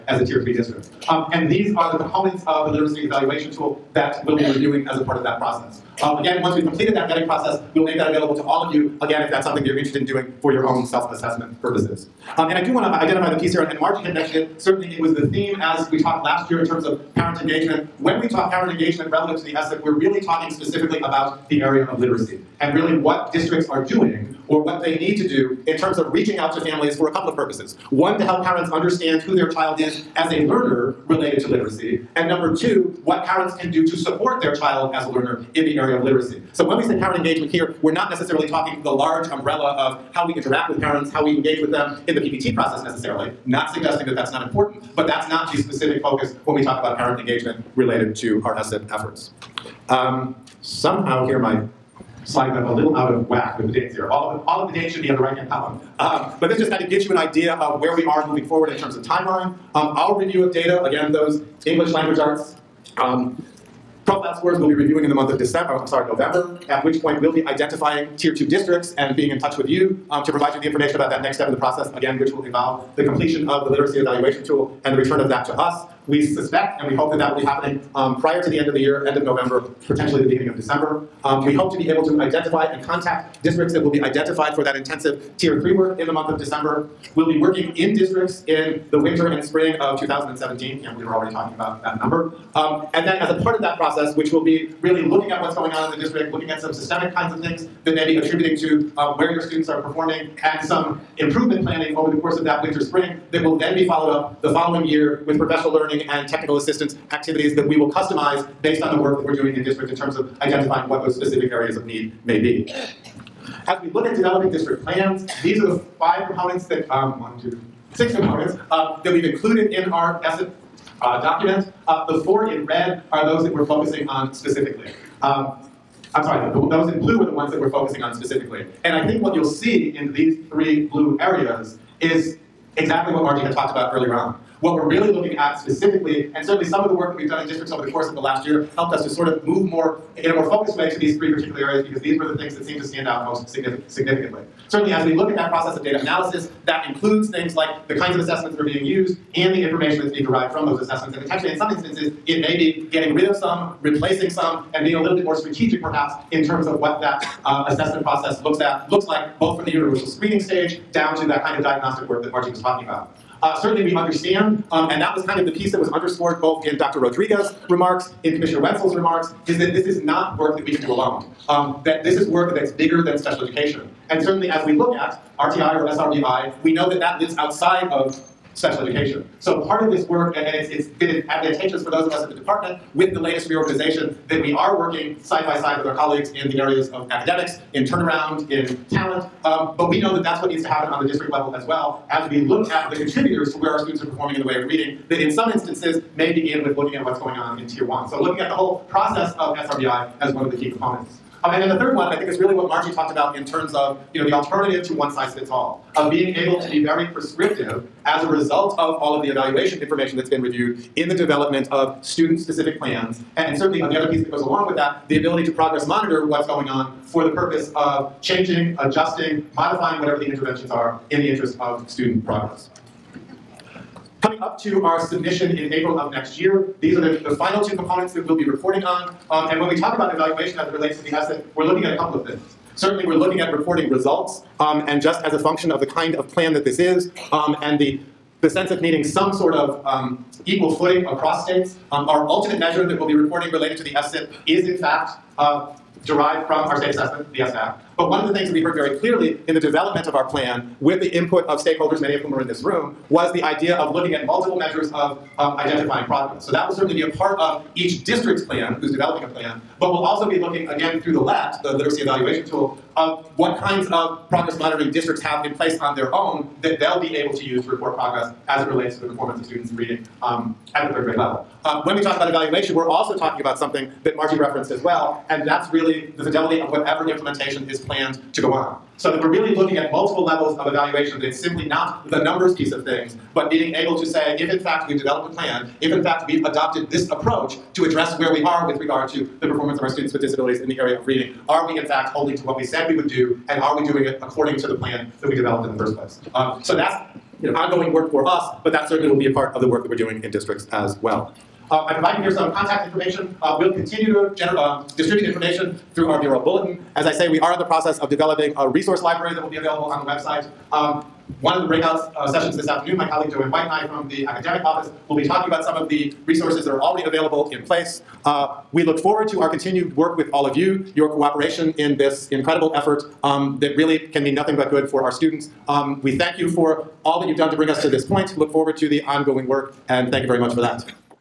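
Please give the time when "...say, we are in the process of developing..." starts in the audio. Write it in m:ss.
5:07.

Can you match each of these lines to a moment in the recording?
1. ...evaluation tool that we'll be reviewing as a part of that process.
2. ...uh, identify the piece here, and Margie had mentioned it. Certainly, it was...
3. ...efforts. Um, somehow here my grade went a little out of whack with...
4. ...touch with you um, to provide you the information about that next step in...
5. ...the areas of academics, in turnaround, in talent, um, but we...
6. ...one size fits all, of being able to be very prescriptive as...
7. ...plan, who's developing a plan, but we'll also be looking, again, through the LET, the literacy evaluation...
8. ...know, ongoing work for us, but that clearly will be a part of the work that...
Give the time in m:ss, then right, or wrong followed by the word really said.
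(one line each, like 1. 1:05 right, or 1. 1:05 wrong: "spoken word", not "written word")
1. 0:03 right
2. 0:12 right
3. 0:48 wrong: "slide", not "grade"
4. 1:09 right
5. 3:06 right
6. 3:24 right
7. 4:18 right
8. 4:57 wrong: "certainly", not "clearly".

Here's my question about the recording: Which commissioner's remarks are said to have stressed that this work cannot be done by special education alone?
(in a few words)
Commissioner Wentzell.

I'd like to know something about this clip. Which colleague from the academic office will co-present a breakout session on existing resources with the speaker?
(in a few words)
Joanne White.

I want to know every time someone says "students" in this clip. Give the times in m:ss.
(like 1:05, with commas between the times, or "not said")
1:39, 3:13, 3:32, 3:41, 4:29, 4:49, 5:25.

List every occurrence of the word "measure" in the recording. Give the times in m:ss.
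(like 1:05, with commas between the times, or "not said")
4:02, 4:14.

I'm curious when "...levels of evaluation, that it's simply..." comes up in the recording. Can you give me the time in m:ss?
4:40.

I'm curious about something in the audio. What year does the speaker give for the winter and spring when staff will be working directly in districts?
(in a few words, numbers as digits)
2017.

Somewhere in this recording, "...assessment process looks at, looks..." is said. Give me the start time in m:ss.
2:37.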